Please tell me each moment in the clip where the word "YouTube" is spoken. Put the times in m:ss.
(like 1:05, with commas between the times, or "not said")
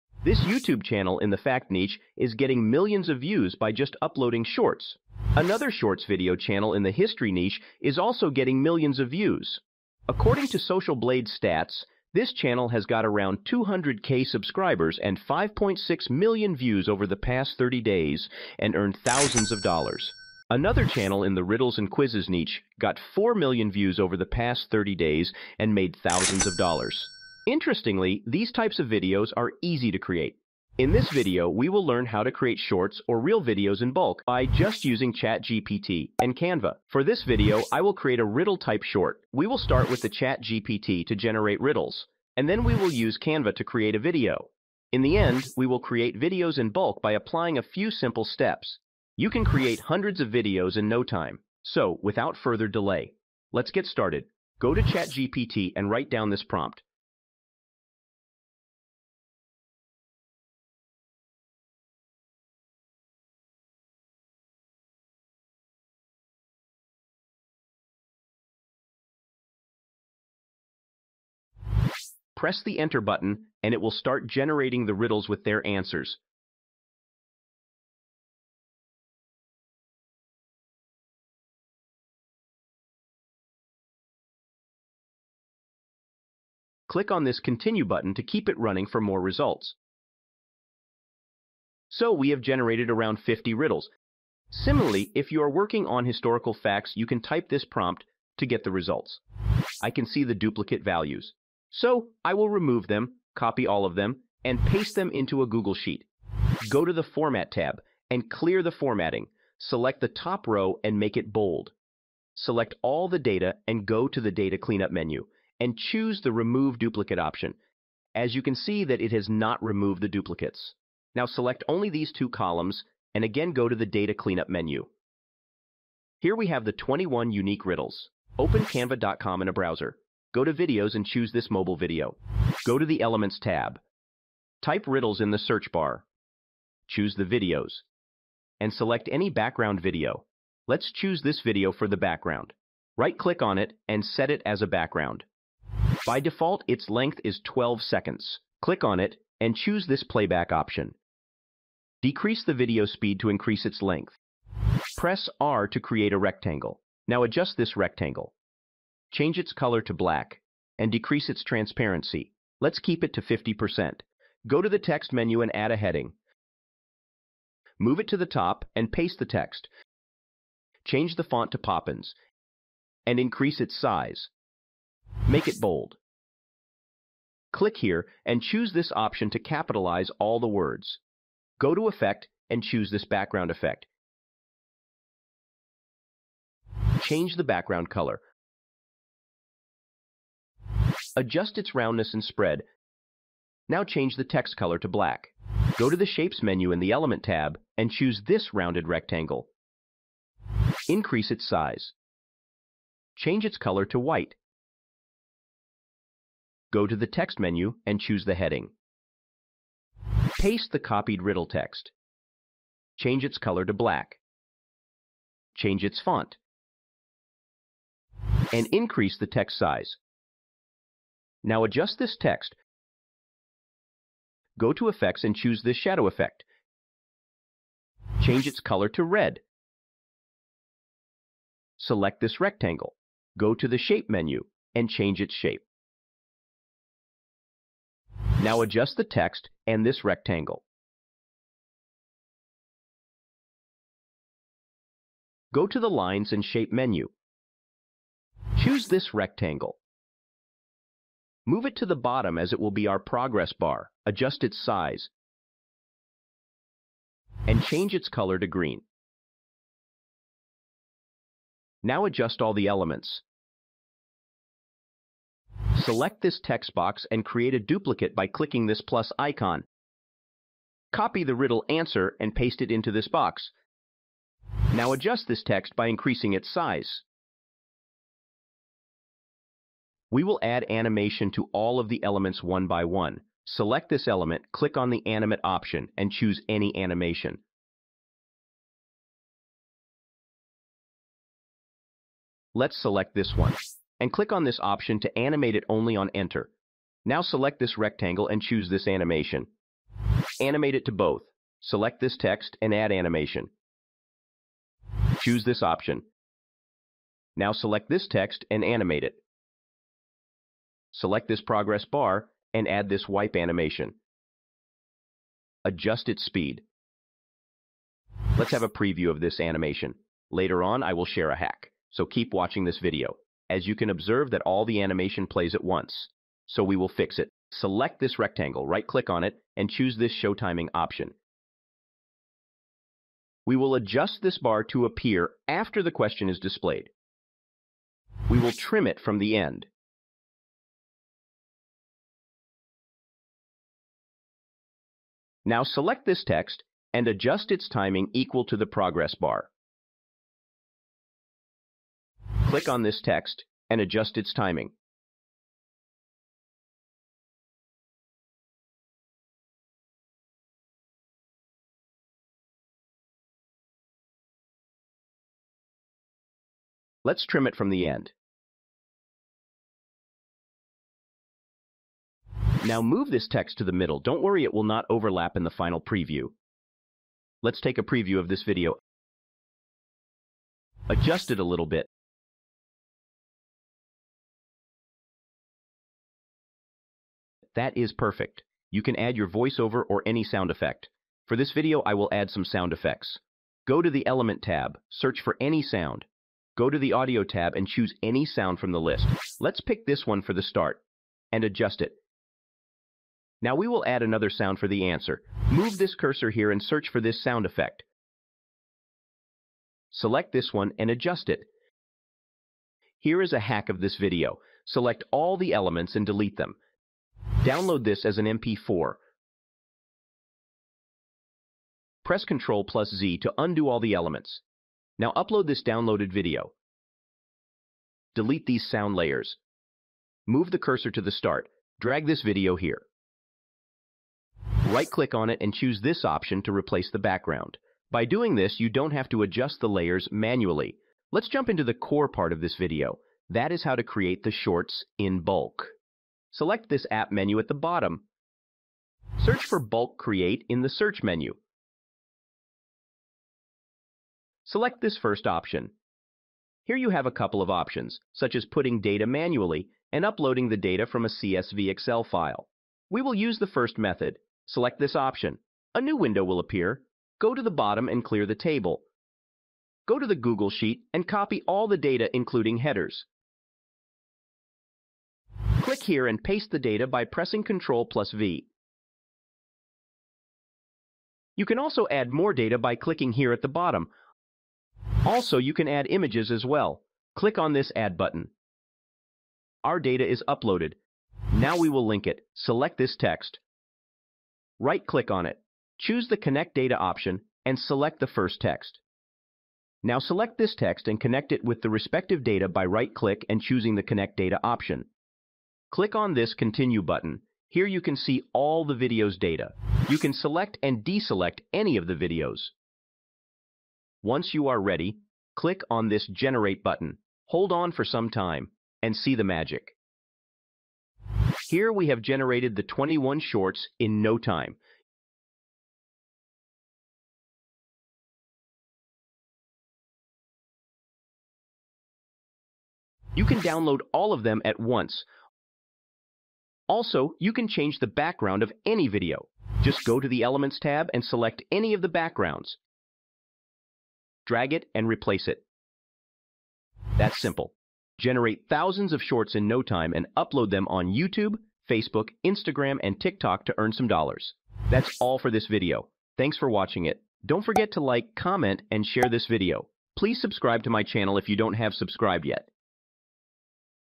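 0:00, 9:10.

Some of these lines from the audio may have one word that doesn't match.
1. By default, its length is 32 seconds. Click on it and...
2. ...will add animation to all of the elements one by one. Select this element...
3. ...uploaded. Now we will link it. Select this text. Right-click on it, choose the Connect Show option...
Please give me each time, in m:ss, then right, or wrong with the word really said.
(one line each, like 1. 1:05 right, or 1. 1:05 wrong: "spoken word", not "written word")
1. 2:26 wrong: "12", not "32"
2. 4:40 right
3. 8:10 wrong: "Data", not "Show".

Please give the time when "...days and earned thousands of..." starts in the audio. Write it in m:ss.
0:17.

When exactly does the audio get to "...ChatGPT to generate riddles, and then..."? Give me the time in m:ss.
0:40.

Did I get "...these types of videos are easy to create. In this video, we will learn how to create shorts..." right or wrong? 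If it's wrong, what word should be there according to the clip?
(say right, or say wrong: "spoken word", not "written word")
right.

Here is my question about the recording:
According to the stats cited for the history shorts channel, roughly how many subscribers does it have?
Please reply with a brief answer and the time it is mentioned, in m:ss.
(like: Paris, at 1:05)
200k, at 0:13.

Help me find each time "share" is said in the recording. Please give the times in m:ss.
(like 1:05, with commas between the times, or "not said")
5:21, 9:18.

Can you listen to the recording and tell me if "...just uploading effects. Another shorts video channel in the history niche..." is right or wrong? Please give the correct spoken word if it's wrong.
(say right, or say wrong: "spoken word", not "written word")
wrong: "shorts", not "effects".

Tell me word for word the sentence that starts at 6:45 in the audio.
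Move this cursor here and search for this sound effect.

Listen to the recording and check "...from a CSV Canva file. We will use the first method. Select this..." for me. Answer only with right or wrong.
wrong.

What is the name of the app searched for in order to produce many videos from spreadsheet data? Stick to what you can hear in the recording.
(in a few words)
Bulk Create.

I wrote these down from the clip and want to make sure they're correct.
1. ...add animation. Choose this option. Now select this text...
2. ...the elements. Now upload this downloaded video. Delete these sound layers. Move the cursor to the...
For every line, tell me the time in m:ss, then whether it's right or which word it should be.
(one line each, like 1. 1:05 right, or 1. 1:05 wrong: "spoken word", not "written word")
1. 5:02 right
2. 7:03 right.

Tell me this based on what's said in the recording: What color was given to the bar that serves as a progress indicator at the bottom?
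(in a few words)
green.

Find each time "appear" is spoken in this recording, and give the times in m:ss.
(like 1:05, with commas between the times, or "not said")
5:34, 7:46.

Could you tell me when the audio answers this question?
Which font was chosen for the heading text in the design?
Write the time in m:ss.
2:51.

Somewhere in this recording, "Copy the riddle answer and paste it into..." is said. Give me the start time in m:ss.
4:30.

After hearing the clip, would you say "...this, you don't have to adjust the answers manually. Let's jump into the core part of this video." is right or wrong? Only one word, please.
wrong.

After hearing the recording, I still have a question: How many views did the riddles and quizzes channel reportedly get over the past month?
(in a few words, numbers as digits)
4 million.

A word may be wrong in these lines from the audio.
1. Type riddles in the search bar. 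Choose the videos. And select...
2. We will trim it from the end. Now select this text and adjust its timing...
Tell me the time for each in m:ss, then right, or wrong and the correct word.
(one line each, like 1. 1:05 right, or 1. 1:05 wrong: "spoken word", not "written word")
1. 2:14 right
2. 5:38 right.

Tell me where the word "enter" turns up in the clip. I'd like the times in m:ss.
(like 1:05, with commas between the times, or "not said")
1:12, 4:56.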